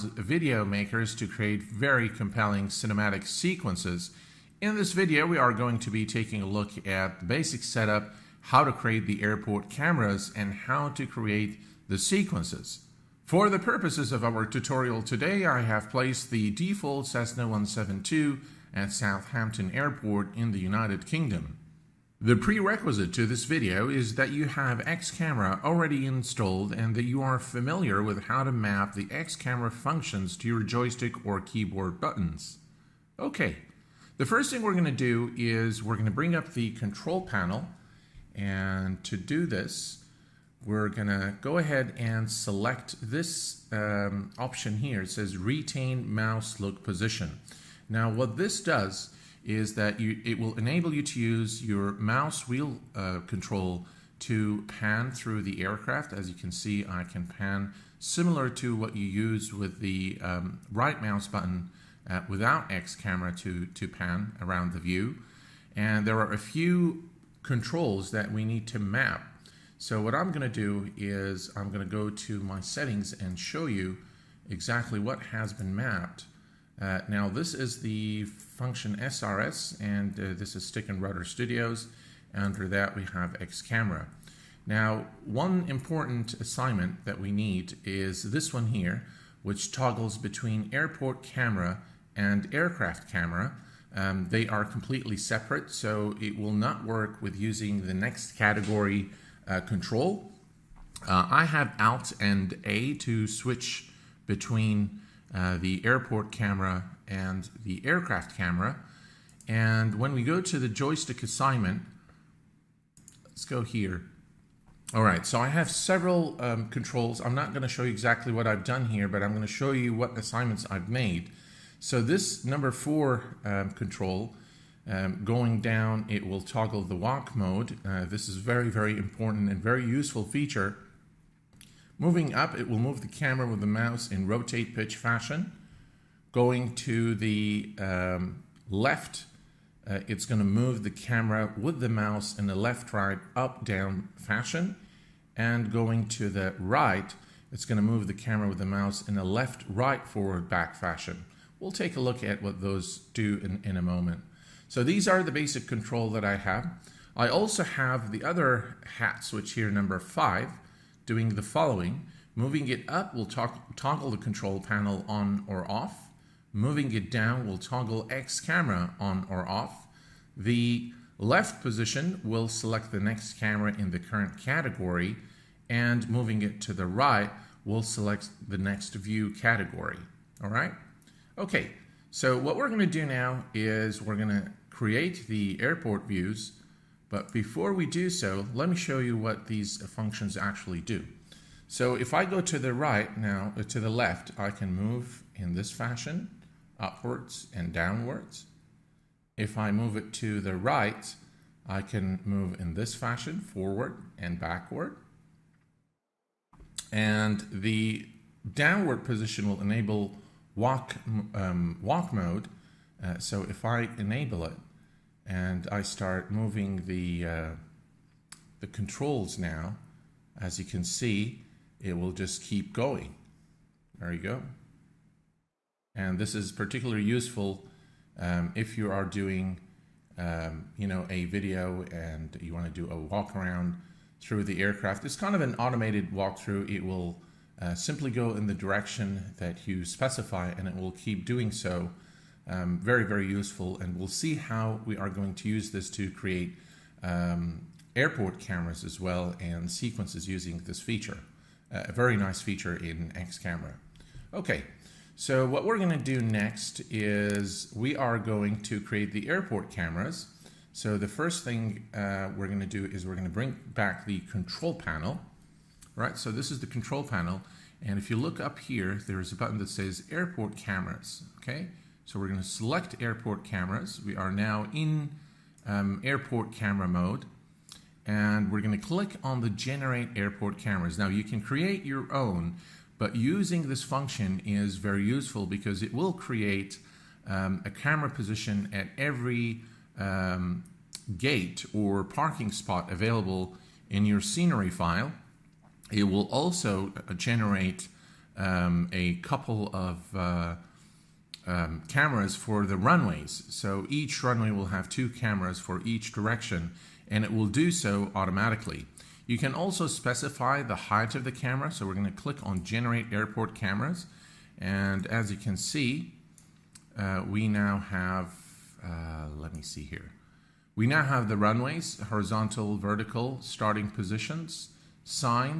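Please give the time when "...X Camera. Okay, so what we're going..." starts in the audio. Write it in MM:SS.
04:13.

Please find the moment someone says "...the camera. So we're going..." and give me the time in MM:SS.
05:11.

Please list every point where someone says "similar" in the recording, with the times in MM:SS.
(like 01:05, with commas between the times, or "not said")
00:57.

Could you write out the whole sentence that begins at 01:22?
Under that we have X Camera.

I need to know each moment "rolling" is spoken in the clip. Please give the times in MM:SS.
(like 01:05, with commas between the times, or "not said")
not said.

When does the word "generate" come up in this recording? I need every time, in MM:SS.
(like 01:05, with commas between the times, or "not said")
04:39, 04:57, 05:12.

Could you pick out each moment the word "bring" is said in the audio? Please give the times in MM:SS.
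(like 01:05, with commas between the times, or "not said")
00:36, 04:23.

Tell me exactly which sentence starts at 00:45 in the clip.
It says retain mouse look position.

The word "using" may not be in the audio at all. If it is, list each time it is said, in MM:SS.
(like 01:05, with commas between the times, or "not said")
01:37, 04:10, 04:43.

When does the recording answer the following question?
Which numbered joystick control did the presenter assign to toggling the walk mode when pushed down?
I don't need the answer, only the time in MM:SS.
02:02.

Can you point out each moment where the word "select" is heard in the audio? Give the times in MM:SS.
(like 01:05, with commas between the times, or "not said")
00:42, 02:52, 02:57, 04:32.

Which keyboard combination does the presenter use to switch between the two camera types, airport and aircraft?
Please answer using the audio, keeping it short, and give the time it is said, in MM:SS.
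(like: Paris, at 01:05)
Alt and A, at 01:41.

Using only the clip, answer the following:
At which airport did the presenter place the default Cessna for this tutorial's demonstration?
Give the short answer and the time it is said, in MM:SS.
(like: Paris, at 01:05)
Southampton Airport, at 00:18.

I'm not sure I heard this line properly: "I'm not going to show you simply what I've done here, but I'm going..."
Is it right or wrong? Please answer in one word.
wrong.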